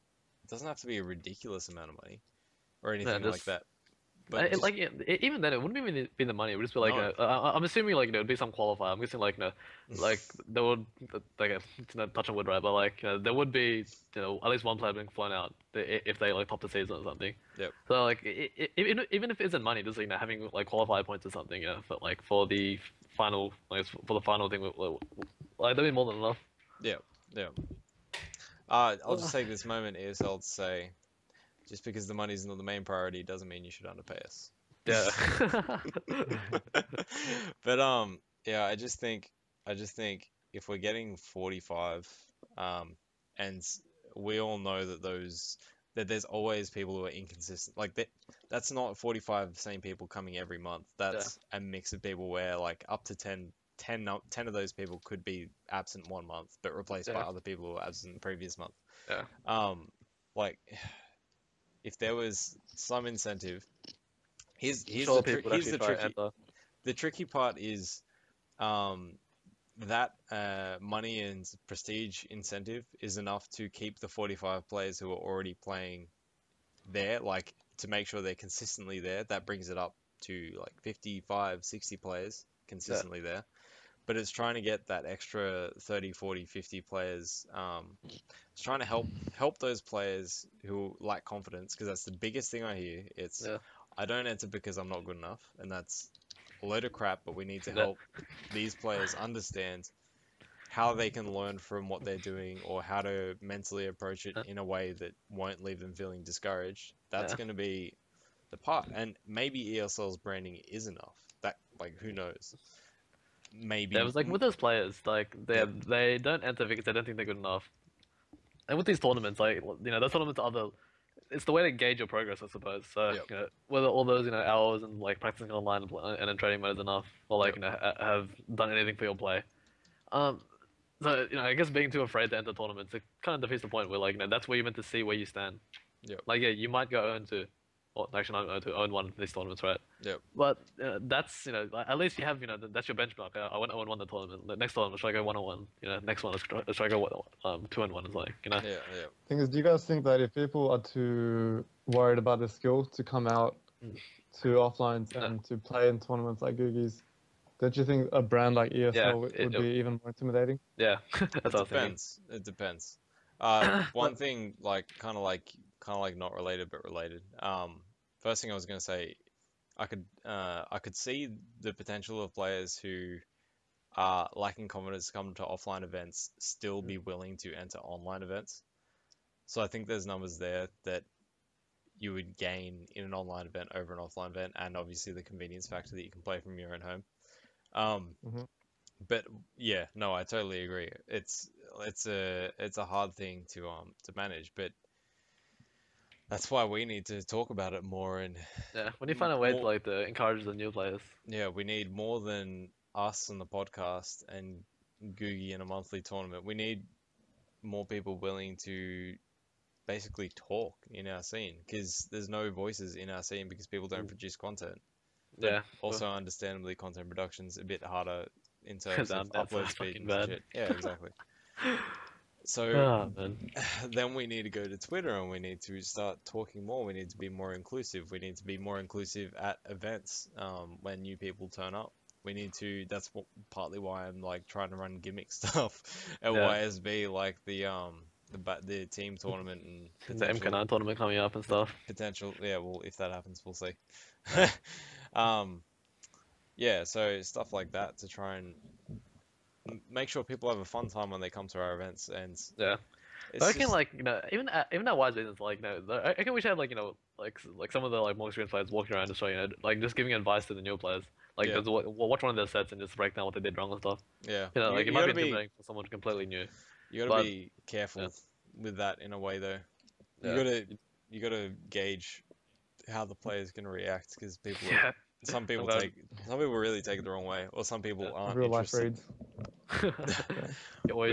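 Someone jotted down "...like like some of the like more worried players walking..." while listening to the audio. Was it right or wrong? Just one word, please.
wrong.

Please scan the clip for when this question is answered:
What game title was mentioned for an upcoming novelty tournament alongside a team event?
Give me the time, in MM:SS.
04:00.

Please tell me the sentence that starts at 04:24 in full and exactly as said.
Yeah, you know, like you, it might be intimidating for someone completely new.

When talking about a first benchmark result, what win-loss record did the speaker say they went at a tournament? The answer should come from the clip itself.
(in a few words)
0-1.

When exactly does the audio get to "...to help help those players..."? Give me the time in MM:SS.
01:28.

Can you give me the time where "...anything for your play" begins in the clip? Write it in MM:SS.
02:08.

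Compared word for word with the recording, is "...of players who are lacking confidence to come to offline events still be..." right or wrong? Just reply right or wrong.
right.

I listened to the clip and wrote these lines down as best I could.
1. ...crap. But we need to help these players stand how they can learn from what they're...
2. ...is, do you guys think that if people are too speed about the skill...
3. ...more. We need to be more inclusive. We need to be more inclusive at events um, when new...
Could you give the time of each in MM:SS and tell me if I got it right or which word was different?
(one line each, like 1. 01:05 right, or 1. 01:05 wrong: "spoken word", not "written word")
1. 01:36 wrong: "understand", not "stand"
2. 02:29 wrong: "worried", not "speed"
3. 03:46 right.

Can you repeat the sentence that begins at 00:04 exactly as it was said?
But it, like it, even then, it wouldn't even be the money.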